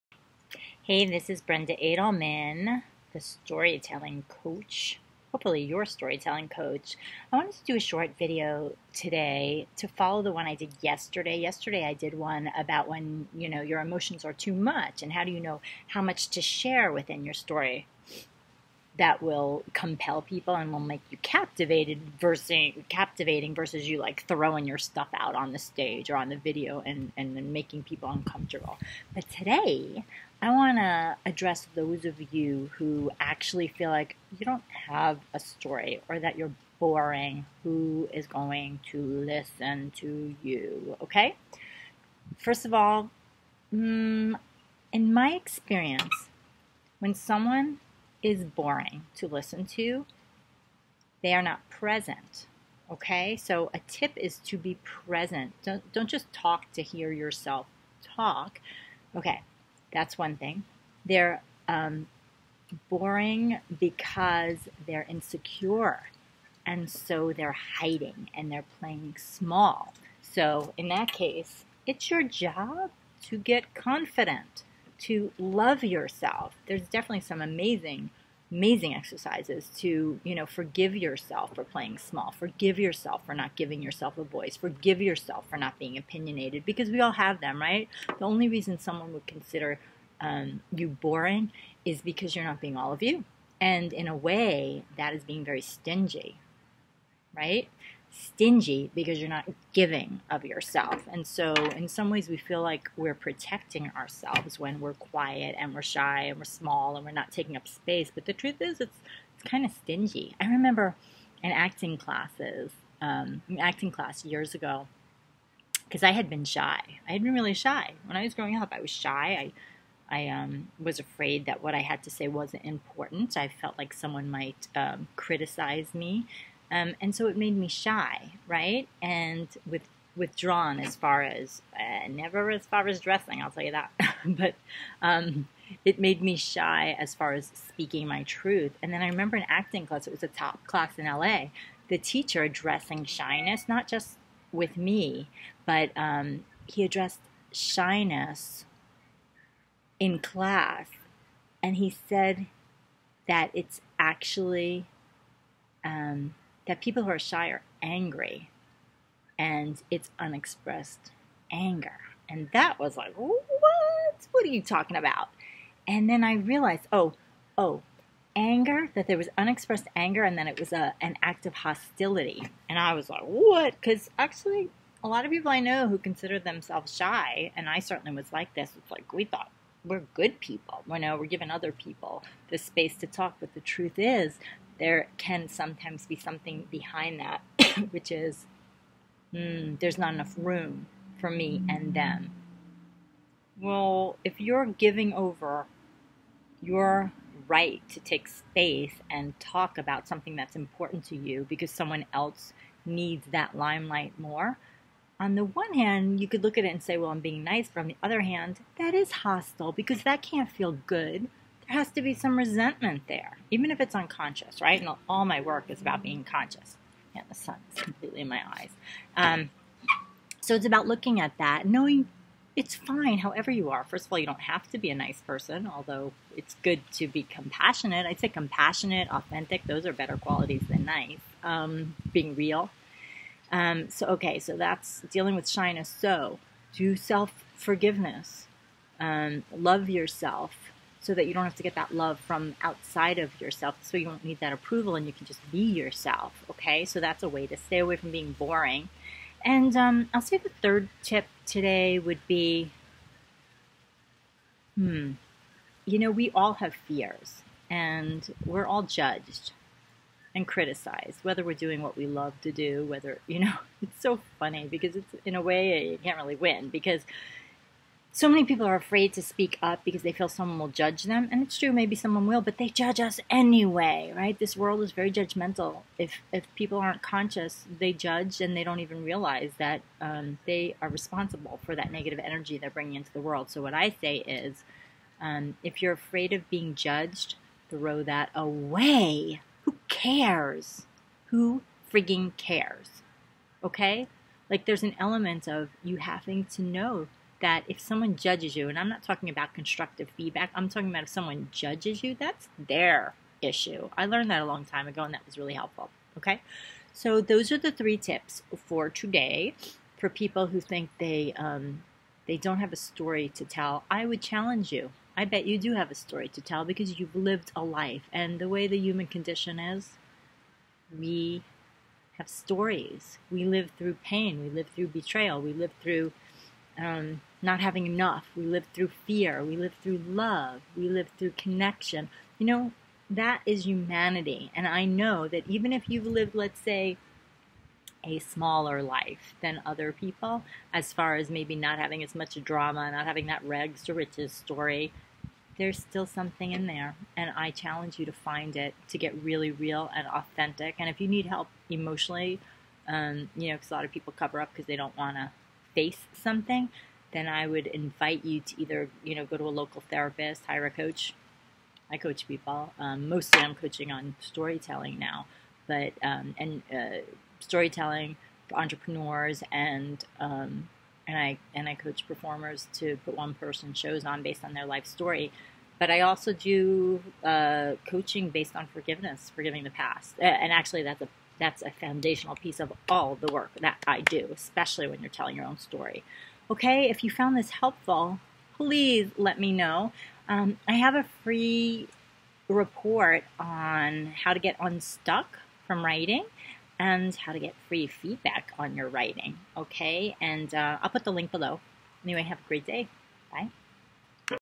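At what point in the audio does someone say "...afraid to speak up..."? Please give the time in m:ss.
4:28.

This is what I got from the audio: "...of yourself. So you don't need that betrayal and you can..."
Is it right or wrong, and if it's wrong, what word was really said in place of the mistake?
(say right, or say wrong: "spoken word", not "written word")
wrong: "approval", not "betrayal".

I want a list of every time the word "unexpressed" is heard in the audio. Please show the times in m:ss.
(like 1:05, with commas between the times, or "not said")
2:40, 2:49.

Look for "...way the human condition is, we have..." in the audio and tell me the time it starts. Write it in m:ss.
5:18.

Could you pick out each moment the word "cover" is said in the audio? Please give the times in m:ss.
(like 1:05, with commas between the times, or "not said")
5:54.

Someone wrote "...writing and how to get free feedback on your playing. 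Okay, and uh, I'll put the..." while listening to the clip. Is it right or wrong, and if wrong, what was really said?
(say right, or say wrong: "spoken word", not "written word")
wrong: "writing", not "playing".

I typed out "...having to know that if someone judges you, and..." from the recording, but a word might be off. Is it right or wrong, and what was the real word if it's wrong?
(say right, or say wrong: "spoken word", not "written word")
right.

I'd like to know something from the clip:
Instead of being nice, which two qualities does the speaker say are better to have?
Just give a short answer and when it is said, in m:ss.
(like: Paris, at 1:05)
compassionate, authentic, at 3:48.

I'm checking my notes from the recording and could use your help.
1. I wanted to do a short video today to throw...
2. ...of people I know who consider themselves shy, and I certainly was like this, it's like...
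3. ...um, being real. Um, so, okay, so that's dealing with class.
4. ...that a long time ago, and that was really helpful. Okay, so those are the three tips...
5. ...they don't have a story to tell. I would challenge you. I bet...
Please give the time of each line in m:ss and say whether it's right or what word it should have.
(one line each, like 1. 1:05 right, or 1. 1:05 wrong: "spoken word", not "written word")
1. 0:07 wrong: "follow", not "throw"
2. 2:55 right
3. 3:51 wrong: "shyness", not "class"
4. 5:04 right
5. 5:12 right.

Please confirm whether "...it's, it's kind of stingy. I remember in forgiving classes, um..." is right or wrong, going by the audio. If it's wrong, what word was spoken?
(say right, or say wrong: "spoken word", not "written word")
wrong: "acting", not "forgiving".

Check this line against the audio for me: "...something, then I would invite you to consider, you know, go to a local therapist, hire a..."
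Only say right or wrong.
wrong.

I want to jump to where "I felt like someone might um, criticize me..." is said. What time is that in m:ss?
2:03.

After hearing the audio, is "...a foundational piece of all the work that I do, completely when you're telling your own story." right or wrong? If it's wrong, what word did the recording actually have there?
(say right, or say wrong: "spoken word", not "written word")
wrong: "especially", not "completely".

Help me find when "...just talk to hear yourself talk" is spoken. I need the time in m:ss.
0:56.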